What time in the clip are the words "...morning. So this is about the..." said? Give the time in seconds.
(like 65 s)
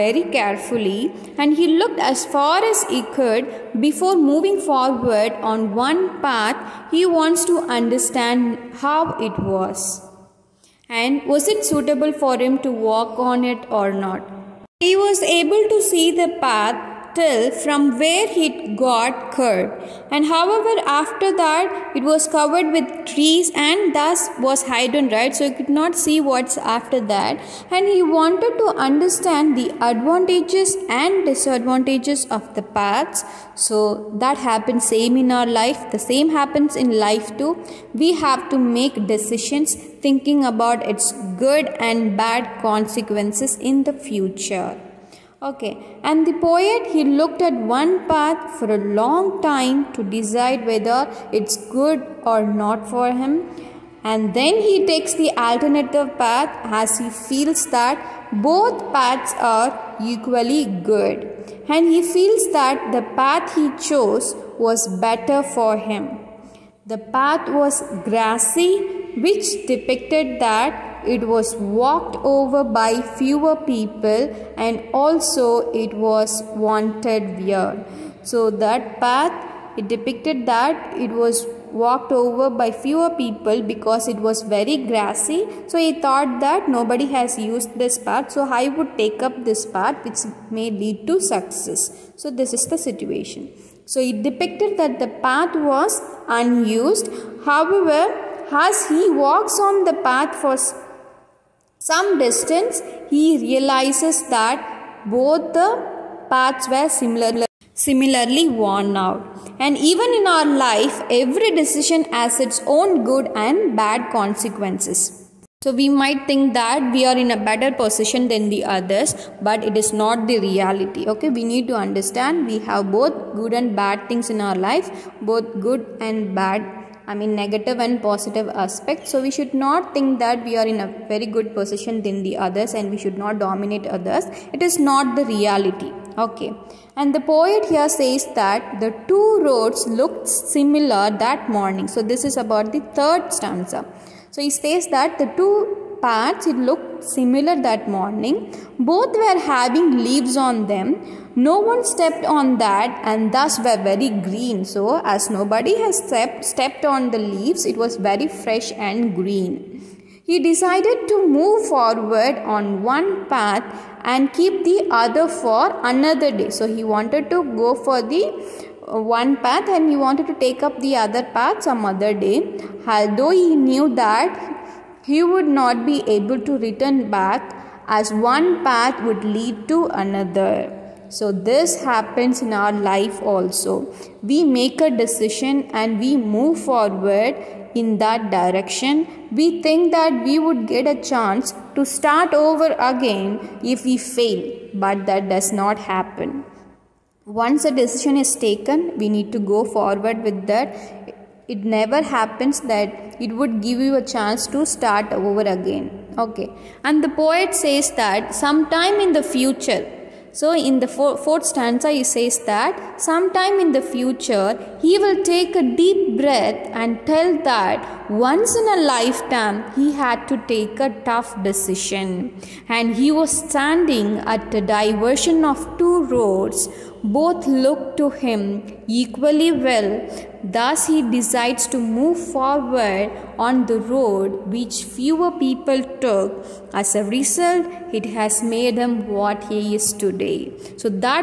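141 s.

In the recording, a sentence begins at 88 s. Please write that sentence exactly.
So I would take up this path which may lead to success.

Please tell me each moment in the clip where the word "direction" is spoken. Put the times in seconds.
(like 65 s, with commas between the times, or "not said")
188 s.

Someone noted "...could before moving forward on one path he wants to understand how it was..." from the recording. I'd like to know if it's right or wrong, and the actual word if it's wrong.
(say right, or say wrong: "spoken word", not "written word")
right.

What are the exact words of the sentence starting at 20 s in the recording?
And however, after that, it was covered with trees and thus was hidden, right?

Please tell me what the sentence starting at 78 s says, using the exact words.
So that path it depicted that it was walked over by fewer people because it was very grassy.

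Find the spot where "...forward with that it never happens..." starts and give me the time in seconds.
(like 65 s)
199 s.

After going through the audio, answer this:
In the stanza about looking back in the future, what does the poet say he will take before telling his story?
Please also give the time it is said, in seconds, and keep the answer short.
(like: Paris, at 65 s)
A deep breath, at 215 s.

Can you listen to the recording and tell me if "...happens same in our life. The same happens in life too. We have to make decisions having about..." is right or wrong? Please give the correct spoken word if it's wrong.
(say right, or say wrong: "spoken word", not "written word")
wrong: "thinking", not "having".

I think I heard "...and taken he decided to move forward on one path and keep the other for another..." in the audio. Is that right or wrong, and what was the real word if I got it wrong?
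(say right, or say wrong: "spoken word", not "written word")
wrong: "green", not "taken".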